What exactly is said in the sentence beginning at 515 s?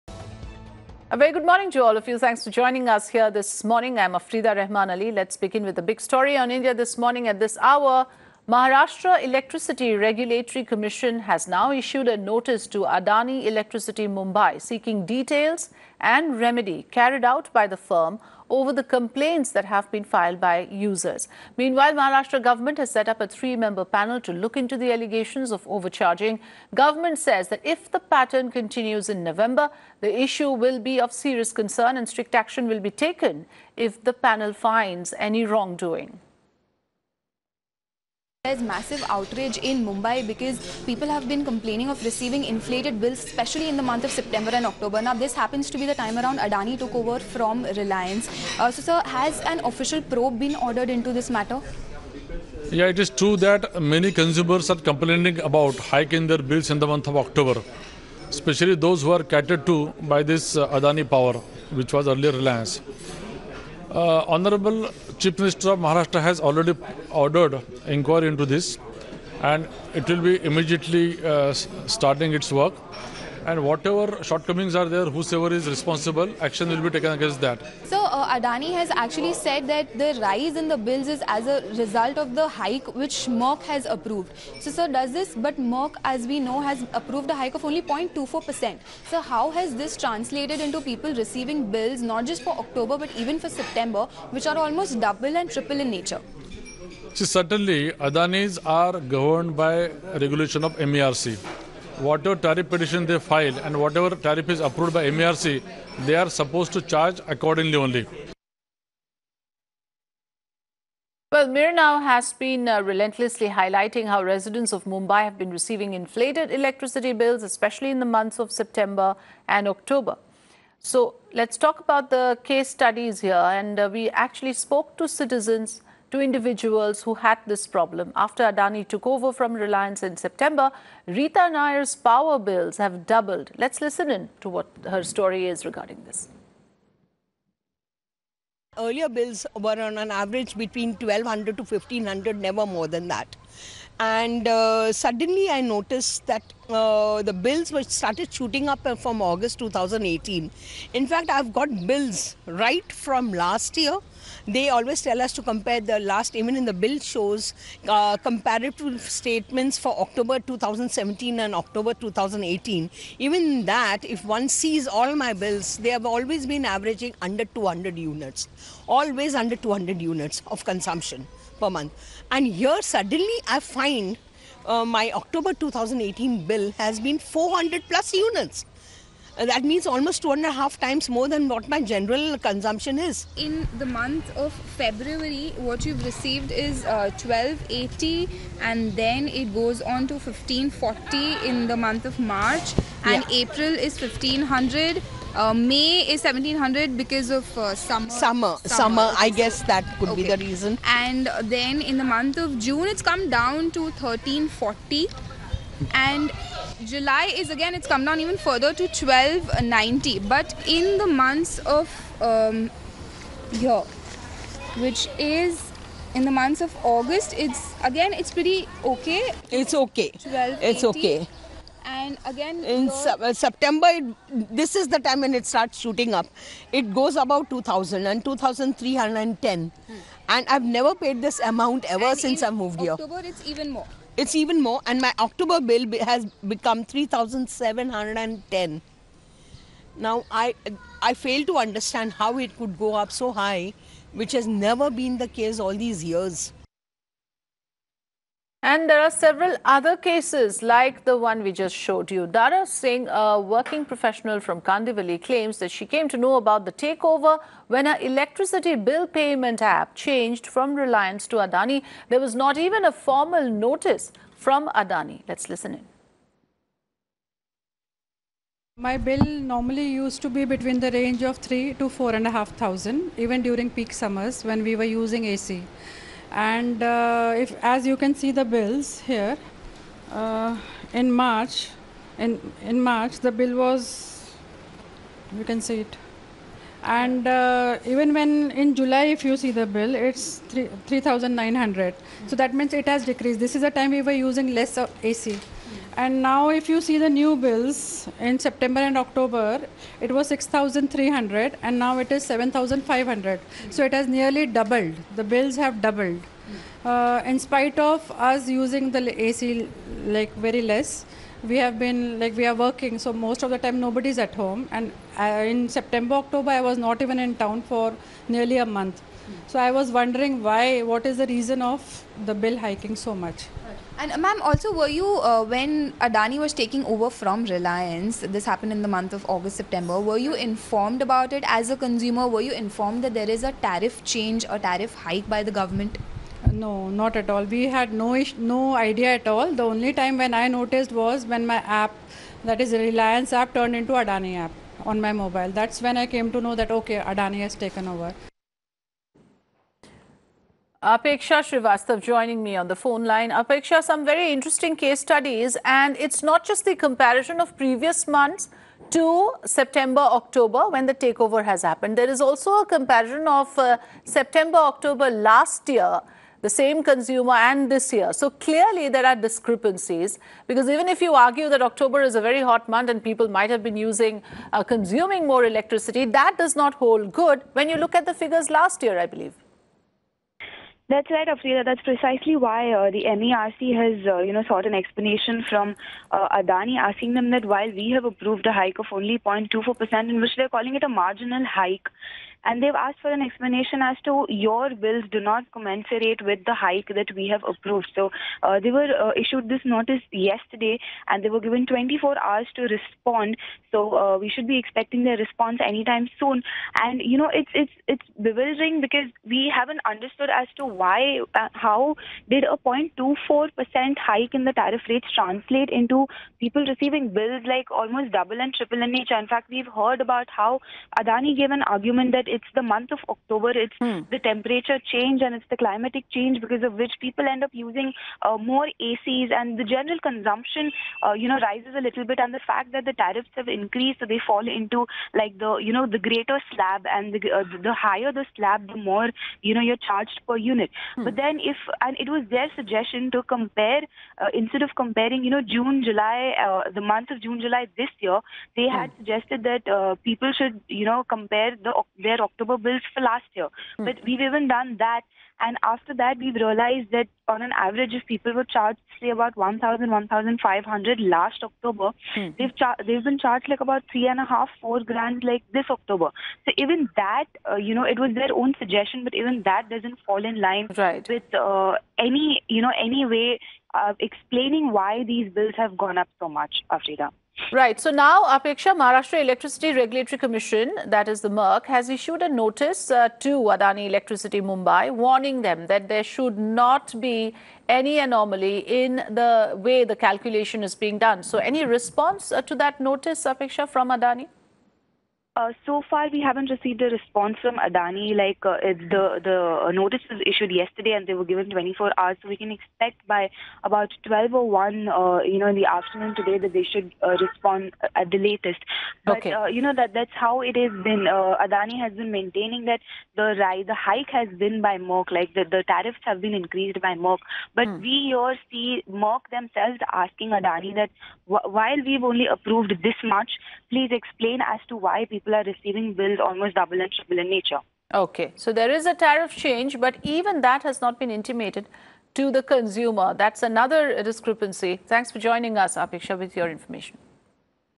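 Like the the tariffs have been increased by MERC.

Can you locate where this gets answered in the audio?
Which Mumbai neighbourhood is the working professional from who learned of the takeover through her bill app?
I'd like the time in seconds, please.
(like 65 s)
254 s.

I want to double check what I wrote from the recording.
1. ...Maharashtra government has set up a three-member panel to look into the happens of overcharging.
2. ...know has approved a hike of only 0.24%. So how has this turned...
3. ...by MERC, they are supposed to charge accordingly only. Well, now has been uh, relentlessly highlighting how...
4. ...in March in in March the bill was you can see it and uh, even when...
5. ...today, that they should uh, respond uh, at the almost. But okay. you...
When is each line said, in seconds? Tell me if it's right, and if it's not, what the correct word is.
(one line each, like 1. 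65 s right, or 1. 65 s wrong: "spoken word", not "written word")
1. 21 s wrong: "allegations", not "happens"
2. 86 s wrong: "translated", not "turned"
3. 104 s right
4. 280 s right
5. 506 s wrong: "latest", not "almost".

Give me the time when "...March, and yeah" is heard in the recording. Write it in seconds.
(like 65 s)
192 s.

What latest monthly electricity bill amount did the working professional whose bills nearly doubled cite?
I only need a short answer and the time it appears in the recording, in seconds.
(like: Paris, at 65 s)
7,500, at 302 s.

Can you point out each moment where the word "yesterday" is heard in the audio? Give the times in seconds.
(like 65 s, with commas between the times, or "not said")
400 s, 500 s.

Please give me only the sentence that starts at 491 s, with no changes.
So, any response uh, to that notice, Apeksha, from Adani?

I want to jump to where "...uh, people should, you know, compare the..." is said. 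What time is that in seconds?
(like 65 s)
449 s.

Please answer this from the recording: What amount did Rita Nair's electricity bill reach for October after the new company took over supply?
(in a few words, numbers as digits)
3,710.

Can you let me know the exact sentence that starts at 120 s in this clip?
So let's talk about the case studies here.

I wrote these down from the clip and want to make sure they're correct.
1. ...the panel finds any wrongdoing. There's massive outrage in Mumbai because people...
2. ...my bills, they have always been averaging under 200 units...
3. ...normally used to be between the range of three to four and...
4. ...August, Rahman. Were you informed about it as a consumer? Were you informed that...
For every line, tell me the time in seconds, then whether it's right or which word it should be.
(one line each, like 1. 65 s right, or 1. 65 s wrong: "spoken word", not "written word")
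1. 34 s right
2. 165 s right
3. 269 s right
4. 329 s wrong: "September", not "Rahman".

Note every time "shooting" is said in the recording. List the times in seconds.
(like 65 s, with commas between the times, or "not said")
148 s, 225 s.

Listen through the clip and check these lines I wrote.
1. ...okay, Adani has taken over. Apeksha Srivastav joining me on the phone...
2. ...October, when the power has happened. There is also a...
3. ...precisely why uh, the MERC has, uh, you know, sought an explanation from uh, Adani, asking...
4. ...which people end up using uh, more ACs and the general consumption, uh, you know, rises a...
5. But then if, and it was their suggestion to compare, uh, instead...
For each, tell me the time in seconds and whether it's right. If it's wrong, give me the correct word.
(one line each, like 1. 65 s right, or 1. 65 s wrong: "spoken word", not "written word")
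1. 346 s right
2. 360 s wrong: "takeover", not "power"
3. 381 s right
4. 426 s right
5. 441 s right.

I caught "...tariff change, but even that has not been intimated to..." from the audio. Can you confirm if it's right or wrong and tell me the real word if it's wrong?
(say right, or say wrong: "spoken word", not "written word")
right.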